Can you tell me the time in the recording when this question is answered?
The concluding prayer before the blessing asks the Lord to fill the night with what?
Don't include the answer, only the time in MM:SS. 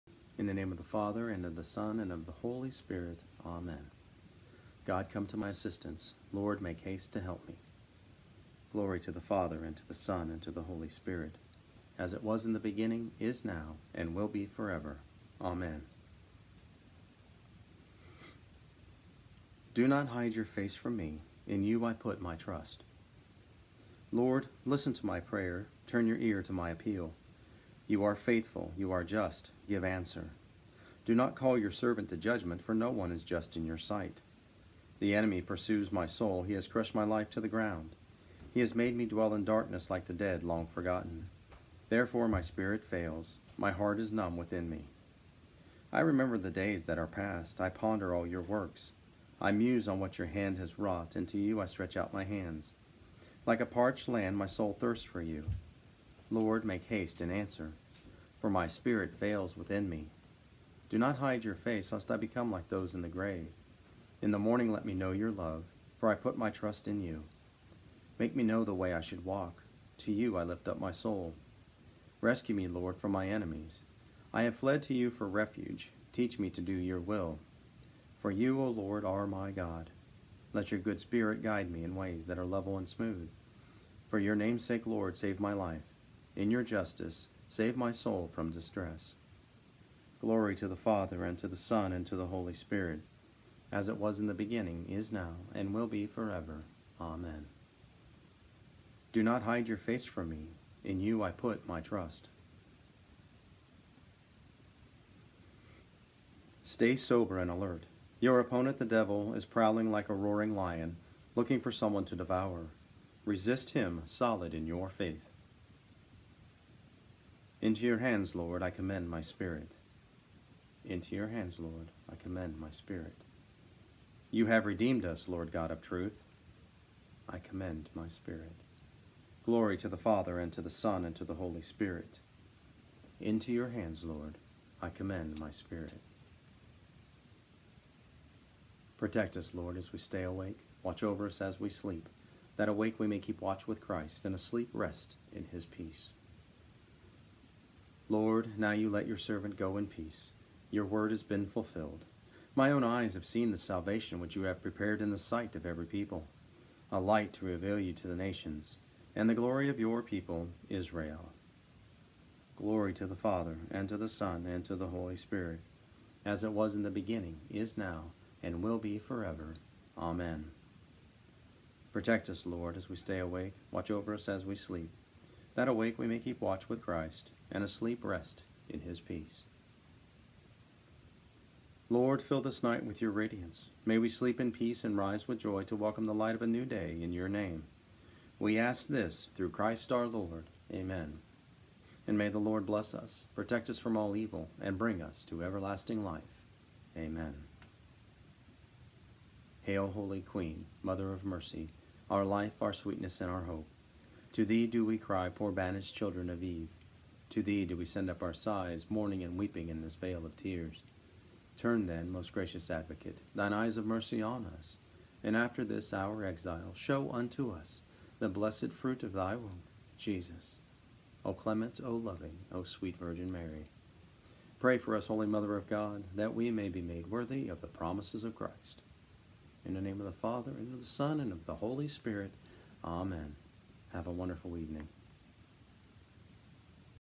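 03:03.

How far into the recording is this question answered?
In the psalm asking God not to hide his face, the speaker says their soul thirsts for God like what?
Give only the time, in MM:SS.
00:53.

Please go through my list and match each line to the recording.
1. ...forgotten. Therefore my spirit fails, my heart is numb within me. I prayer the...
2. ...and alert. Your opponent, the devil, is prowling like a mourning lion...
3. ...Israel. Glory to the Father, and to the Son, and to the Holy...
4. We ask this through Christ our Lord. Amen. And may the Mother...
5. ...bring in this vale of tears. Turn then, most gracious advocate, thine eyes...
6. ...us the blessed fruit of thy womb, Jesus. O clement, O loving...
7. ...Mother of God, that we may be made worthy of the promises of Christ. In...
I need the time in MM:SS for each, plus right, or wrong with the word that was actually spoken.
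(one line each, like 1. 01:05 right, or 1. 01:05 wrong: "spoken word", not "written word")
1. 00:40 wrong: "remember", not "prayer"
2. 01:47 wrong: "roaring", not "mourning"
3. 02:40 right
4. 03:08 wrong: "Lord", not "Mother"
5. 03:29 wrong: "weeping", not "bring"
6. 03:37 right
7. 03:45 right.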